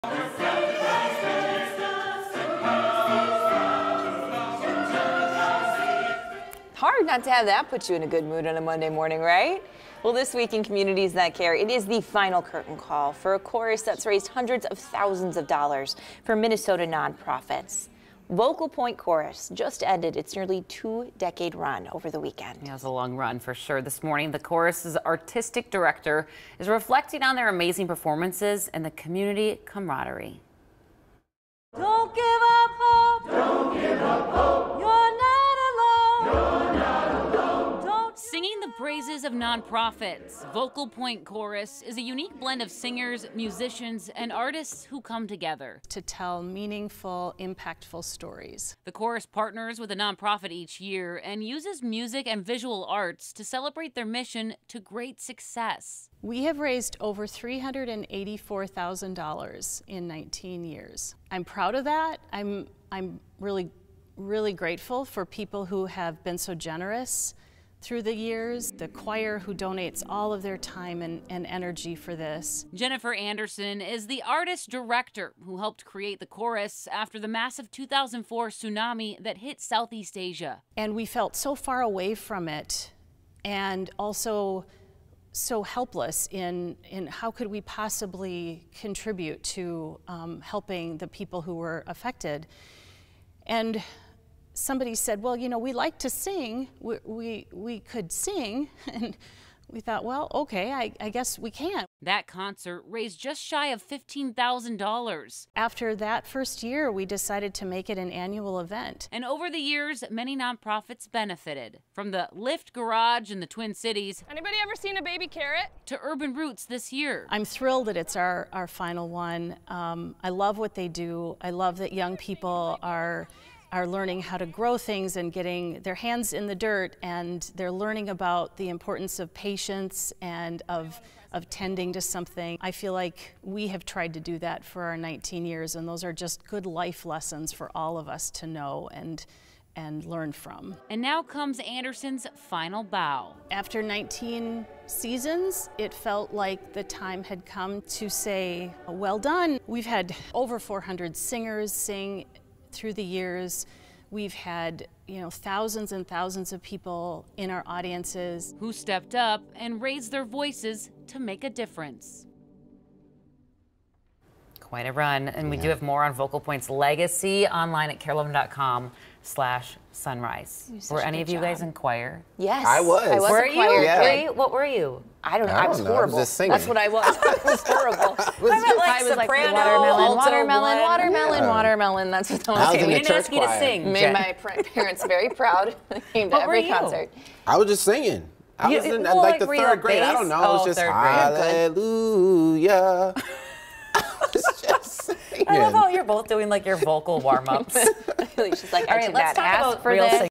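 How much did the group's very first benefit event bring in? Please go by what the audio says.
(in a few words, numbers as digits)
just shy of $15,000.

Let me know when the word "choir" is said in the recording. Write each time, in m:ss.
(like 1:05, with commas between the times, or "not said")
1:08, 2:51, 3:03.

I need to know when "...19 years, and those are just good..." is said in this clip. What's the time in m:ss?
2:14.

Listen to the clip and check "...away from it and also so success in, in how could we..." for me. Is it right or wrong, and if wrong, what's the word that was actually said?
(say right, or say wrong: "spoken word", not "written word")
wrong: "helpless", not "success".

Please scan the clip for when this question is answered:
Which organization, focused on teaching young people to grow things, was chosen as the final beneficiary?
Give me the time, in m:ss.
1:56.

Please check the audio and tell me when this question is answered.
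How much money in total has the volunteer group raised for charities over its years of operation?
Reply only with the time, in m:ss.
0:57.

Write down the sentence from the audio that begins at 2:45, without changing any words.
we do have more on vocal points legacy online at kare11.com slash sunrise.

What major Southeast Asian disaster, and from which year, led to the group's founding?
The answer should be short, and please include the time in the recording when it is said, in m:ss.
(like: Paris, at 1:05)
2004 tsunami, at 1:17.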